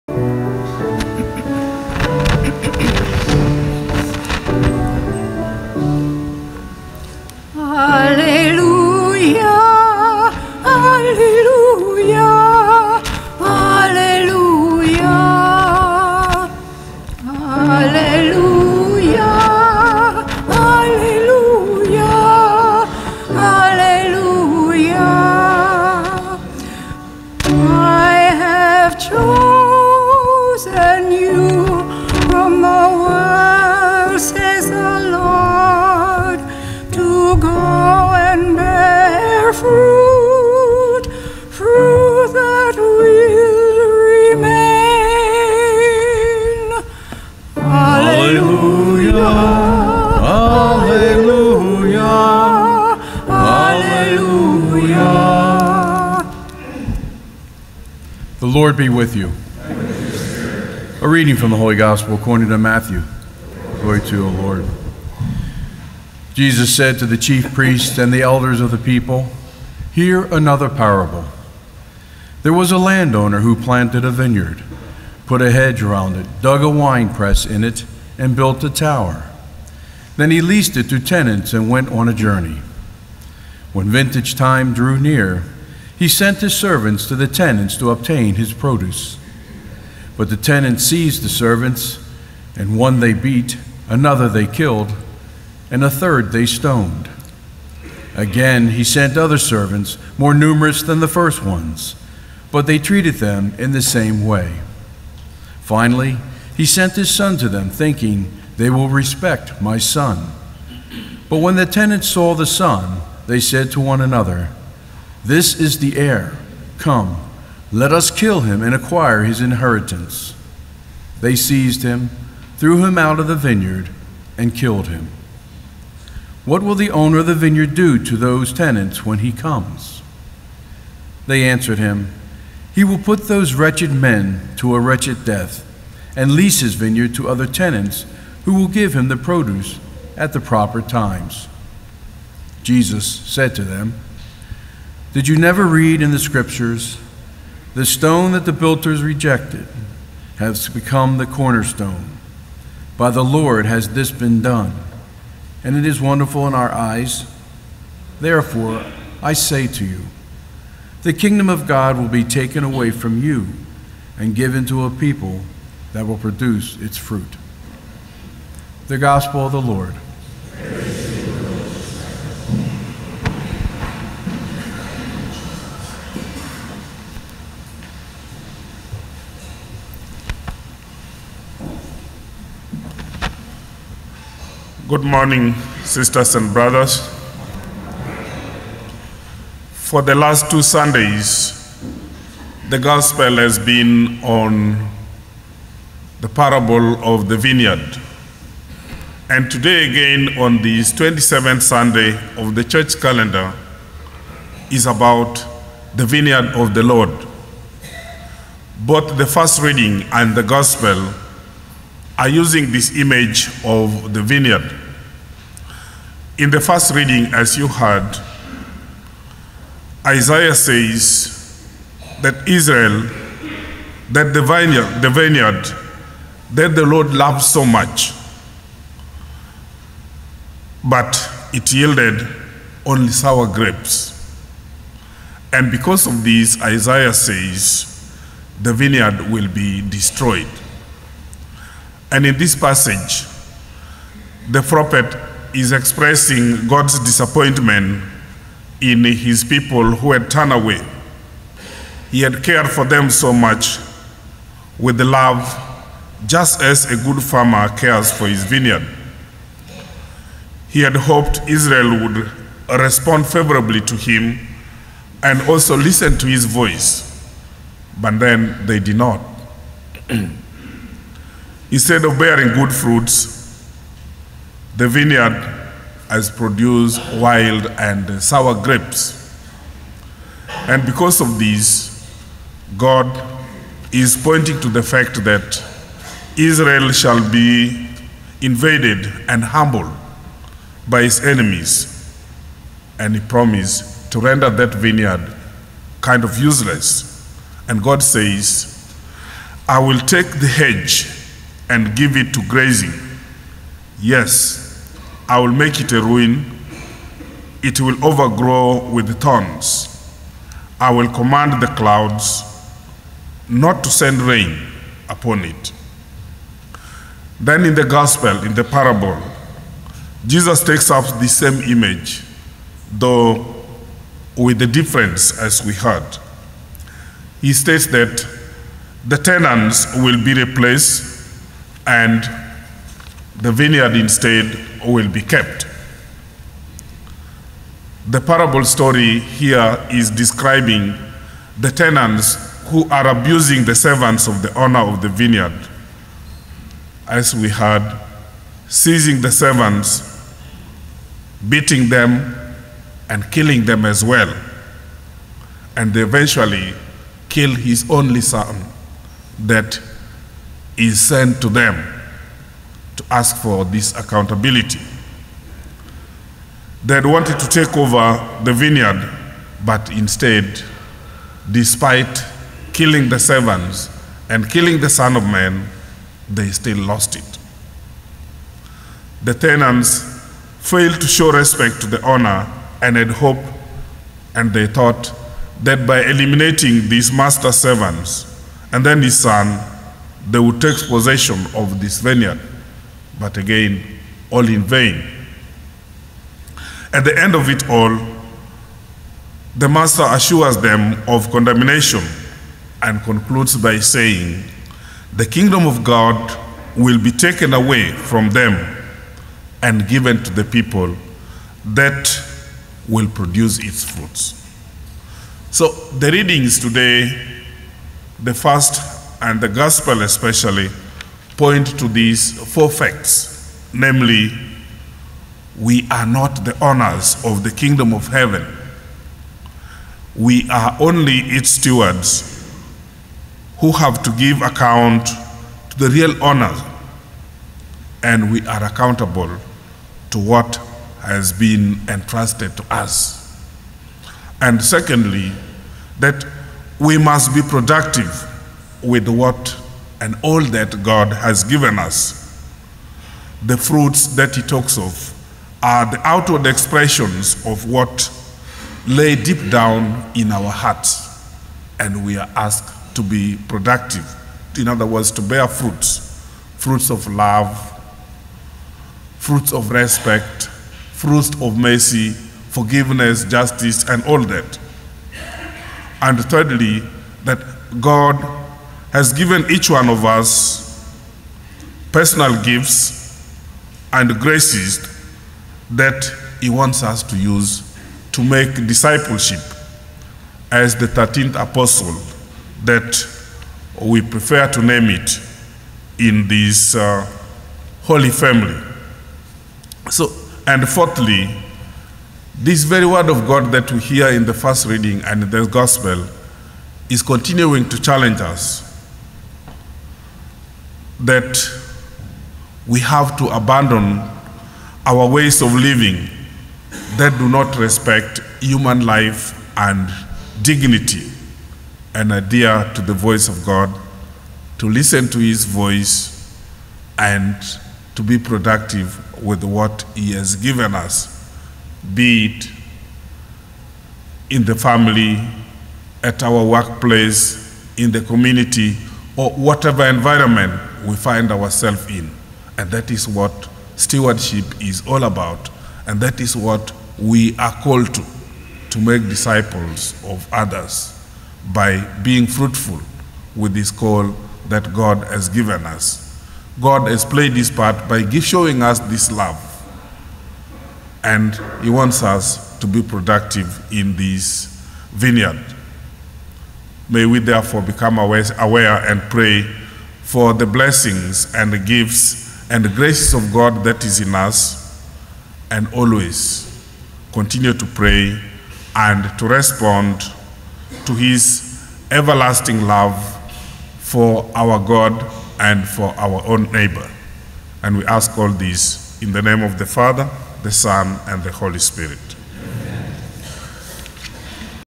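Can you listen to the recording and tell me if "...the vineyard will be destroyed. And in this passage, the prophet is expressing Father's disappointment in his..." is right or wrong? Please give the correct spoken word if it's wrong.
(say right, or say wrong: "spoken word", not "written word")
wrong: "God", not "Father".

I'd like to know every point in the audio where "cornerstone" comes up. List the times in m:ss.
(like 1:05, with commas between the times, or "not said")
2:31.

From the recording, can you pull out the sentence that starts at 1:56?
Come, let us kill him and acquire his inheritance.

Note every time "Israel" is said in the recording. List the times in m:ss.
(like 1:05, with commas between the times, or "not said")
3:42, 4:21, 4:46.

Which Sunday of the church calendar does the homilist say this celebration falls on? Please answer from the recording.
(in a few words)
27th.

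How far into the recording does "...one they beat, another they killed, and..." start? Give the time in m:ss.
1:32.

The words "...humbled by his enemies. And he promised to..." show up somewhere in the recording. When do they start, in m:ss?
4:49.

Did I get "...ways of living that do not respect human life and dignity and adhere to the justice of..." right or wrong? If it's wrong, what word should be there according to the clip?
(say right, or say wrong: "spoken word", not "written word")
wrong: "voice", not "justice".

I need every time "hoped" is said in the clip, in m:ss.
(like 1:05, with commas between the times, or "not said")
4:20, 6:23.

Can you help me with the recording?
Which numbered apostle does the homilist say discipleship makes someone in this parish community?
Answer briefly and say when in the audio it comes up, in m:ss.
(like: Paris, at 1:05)
13th, at 8:10.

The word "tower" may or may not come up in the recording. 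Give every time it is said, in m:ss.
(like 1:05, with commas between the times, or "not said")
1:18.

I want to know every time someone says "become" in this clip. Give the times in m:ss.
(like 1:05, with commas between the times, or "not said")
2:30, 9:27.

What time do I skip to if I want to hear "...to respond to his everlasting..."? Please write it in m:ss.
9:39.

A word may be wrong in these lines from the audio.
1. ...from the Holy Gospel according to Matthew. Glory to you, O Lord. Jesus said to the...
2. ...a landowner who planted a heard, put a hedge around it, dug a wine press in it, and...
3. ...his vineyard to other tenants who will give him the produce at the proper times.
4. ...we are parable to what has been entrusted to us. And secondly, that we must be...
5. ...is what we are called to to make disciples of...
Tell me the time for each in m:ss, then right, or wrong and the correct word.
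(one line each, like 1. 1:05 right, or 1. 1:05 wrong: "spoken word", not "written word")
1. 1:01 right
2. 1:12 wrong: "vineyard", not "heard"
3. 2:16 right
4. 7:18 wrong: "accountable", not "parable"
5. 9:06 right.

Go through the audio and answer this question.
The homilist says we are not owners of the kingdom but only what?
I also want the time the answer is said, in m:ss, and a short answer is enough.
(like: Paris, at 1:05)
Stewards, at 7:11.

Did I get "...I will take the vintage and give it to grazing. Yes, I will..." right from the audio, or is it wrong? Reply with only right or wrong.
wrong.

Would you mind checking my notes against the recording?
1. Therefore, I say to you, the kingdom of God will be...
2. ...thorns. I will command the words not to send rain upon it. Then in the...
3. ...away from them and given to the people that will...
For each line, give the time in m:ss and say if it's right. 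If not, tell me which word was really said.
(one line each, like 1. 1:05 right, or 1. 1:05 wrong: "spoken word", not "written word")
1. 2:38 right
2. 5:09 wrong: "clouds", not "words"
3. 6:47 right.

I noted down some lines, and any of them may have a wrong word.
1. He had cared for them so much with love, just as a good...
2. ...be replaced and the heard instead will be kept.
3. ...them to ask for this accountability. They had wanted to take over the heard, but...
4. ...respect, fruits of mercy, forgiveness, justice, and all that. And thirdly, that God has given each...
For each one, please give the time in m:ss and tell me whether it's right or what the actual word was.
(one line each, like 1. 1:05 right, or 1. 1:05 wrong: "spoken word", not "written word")
1. 4:12 right
2. 5:30 wrong: "vineyard", not "heard"
3. 6:01 wrong: "vineyard", not "heard"
4. 7:49 right.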